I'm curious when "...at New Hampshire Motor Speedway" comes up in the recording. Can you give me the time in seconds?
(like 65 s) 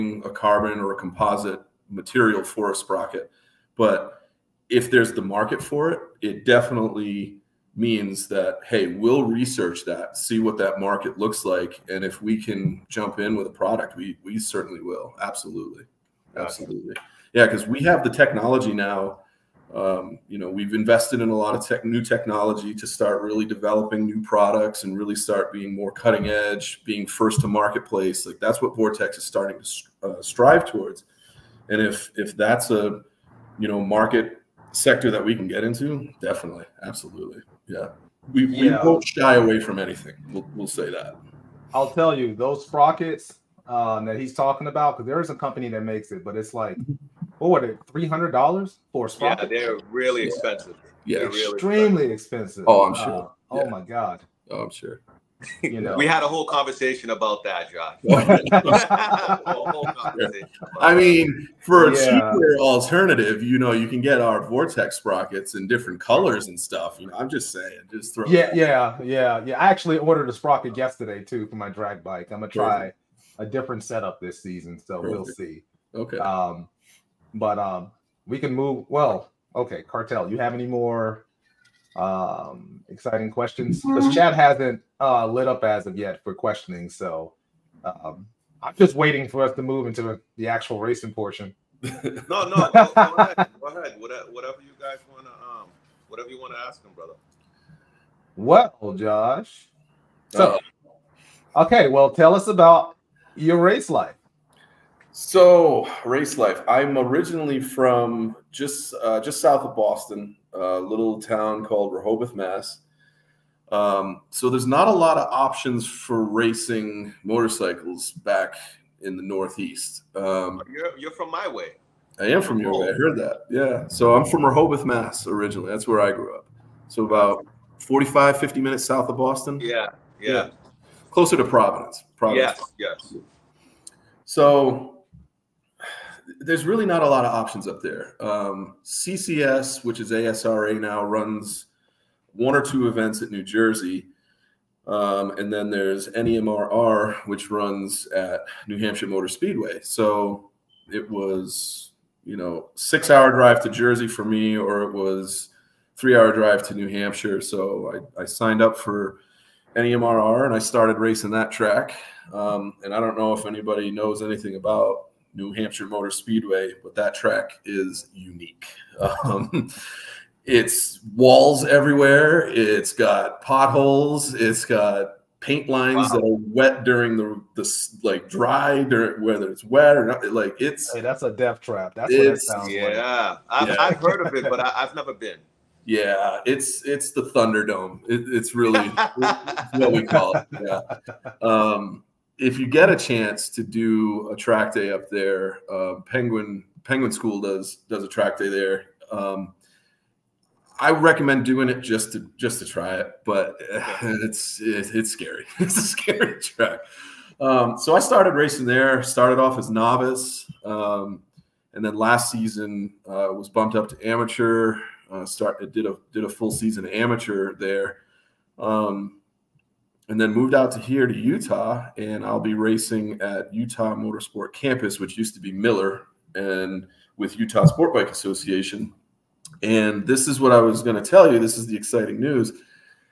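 148 s.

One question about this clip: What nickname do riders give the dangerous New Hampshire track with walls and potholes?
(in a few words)
The Thunderdome.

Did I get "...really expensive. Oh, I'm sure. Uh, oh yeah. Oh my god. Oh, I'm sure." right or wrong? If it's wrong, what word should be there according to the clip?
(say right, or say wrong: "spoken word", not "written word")
right.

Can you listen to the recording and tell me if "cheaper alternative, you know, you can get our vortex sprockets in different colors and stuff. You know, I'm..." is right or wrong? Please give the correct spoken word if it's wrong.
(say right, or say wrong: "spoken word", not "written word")
right.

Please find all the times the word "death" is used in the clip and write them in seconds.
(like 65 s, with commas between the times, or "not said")
181 s.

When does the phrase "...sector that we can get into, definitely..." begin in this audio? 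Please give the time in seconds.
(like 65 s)
34 s.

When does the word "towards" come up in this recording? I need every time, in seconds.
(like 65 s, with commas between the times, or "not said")
30 s.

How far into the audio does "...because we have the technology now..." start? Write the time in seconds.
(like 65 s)
17 s.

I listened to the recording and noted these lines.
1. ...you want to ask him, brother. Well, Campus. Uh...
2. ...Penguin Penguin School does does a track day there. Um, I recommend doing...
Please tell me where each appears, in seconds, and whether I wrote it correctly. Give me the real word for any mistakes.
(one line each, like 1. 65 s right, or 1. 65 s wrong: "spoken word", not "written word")
1. 96 s wrong: "Josh", not "Campus"
2. 196 s right.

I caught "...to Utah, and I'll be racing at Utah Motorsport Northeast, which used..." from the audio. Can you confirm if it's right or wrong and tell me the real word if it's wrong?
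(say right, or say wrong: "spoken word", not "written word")
wrong: "Campus", not "Northeast".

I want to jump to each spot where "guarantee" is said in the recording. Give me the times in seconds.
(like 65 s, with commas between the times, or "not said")
not said.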